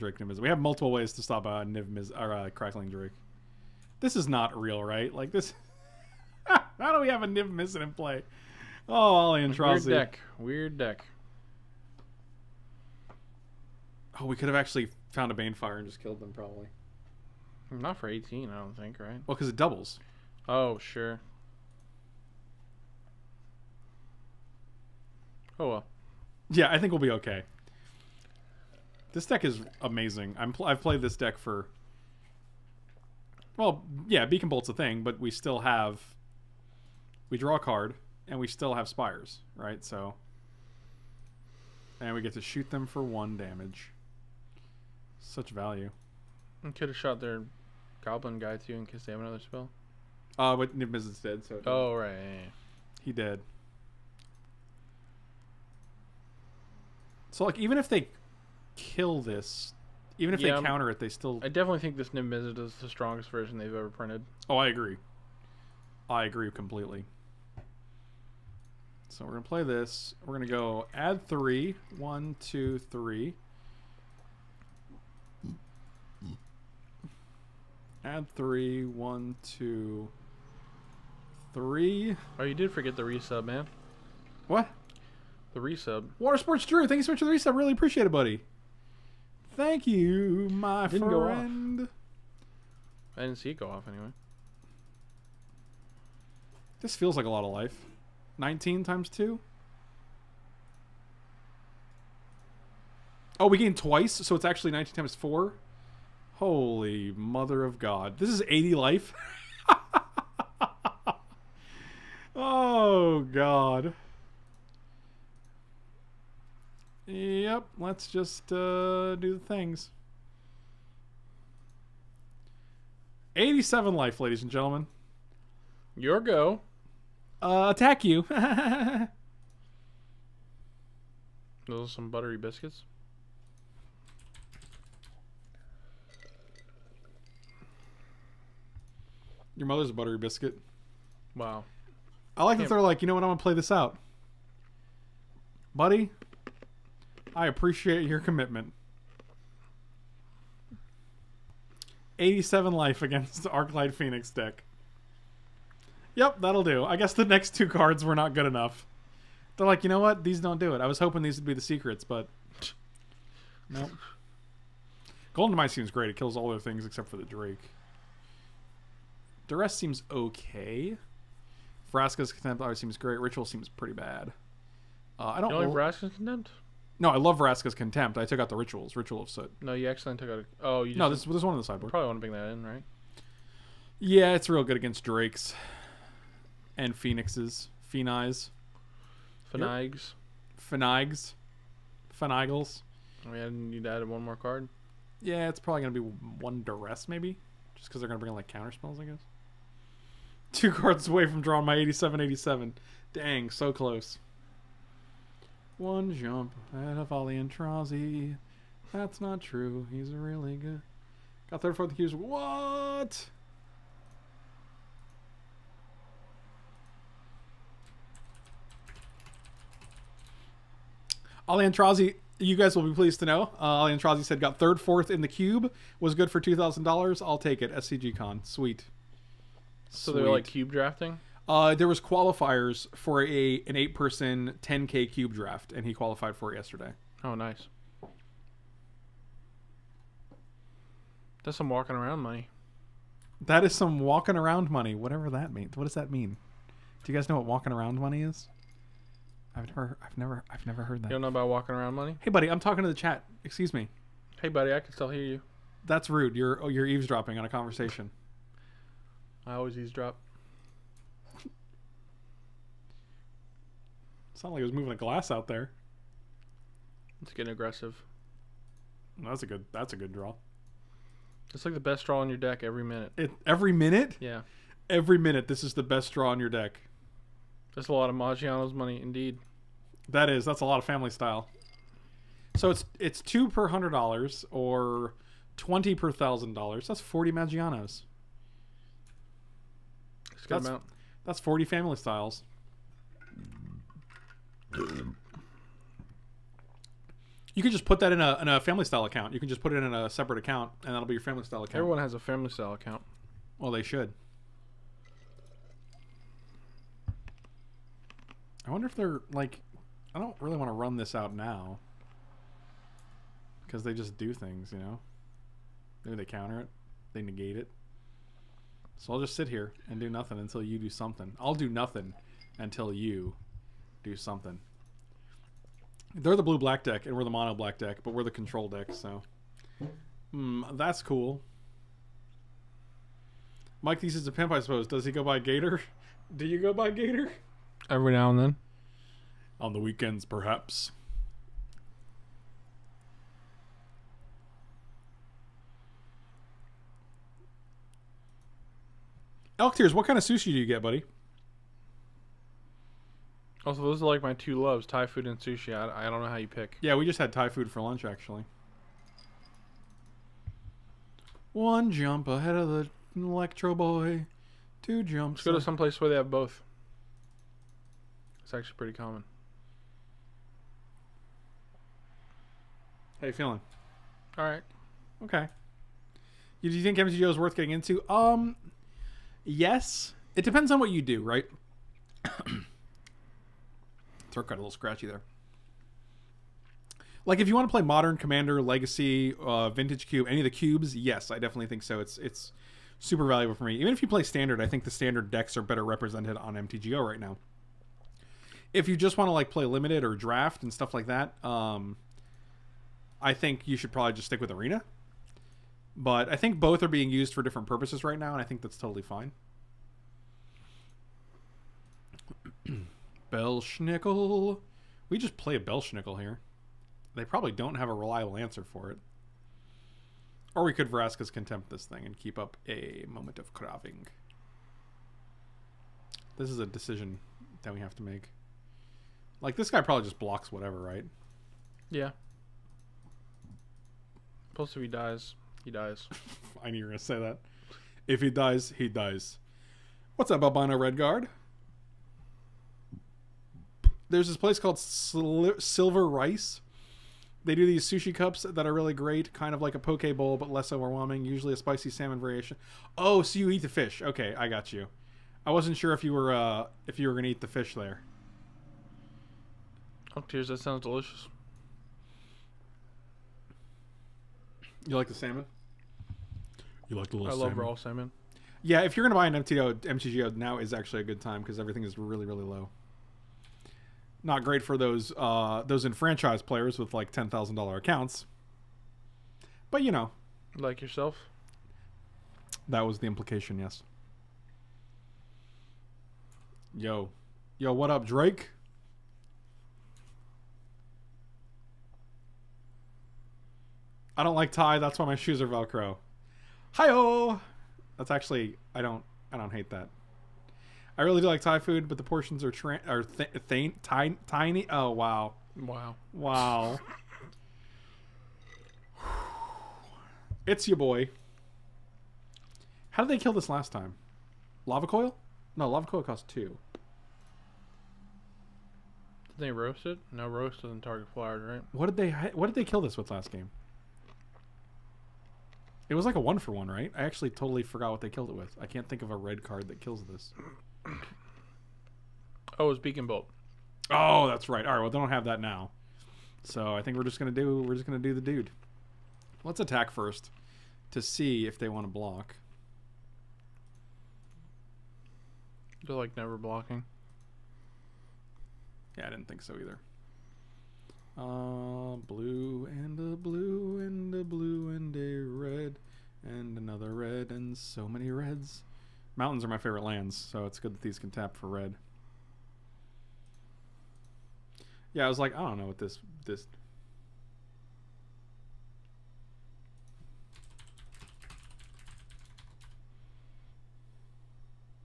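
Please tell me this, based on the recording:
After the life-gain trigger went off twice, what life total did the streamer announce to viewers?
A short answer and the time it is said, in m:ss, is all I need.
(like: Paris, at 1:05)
87, at 2:03.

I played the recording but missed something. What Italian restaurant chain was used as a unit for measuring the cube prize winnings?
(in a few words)
Maggiano's.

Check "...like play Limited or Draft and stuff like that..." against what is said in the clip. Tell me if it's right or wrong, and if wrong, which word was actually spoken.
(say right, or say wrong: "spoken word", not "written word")
right.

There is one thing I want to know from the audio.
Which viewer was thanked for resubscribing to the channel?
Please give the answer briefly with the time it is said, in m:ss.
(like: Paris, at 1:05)
Water Sports Drew, at 1:26.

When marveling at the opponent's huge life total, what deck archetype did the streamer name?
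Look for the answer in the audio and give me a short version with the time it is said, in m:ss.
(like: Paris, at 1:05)
Arclight Phoenix, at 2:33.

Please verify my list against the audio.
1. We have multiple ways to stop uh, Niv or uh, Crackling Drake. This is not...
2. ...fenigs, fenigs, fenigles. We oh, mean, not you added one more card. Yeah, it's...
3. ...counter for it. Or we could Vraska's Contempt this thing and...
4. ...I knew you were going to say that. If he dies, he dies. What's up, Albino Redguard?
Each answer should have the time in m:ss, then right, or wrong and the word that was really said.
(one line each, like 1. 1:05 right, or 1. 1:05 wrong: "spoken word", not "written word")
1. 0:00 right
2. 3:09 right
3. 6:58 wrong: "answer", not "counter"
4. 7:16 right.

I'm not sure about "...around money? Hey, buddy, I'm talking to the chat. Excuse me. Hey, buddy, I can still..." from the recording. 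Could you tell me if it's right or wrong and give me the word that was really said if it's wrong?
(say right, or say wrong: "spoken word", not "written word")
right.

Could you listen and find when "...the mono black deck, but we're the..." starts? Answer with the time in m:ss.
5:27.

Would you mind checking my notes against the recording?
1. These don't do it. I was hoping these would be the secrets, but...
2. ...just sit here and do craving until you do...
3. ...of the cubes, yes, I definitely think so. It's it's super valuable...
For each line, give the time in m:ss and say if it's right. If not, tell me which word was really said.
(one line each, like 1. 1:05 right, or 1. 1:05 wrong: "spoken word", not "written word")
1. 2:40 right
2. 5:19 wrong: "nothing", not "craving"
3. 6:30 right.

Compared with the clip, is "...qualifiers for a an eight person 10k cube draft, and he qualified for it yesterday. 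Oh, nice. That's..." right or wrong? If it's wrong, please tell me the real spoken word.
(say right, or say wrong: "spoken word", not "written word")
right.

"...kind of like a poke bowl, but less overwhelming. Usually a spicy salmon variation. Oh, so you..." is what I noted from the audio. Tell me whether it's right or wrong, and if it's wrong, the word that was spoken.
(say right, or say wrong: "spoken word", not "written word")
right.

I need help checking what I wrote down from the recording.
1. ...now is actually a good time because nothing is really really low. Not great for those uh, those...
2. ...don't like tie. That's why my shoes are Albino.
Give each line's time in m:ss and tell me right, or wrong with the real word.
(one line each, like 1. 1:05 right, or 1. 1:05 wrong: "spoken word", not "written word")
1. 7:50 wrong: "everything", not "nothing"
2. 8:14 wrong: "Velcro", not "Albino".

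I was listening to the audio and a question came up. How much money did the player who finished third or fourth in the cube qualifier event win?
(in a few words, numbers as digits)
$2,000.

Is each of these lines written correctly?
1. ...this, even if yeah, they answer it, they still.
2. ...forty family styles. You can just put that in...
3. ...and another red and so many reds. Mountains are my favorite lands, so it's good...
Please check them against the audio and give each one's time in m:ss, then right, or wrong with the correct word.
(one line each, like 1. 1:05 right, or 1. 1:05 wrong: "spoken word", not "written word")
1. 0:59 wrong: "counter", not "answer"
2. 4:51 right
3. 9:16 right.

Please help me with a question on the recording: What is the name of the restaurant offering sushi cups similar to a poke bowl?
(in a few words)
Silver Rice.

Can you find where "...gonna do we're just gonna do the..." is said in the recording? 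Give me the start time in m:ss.
8:57.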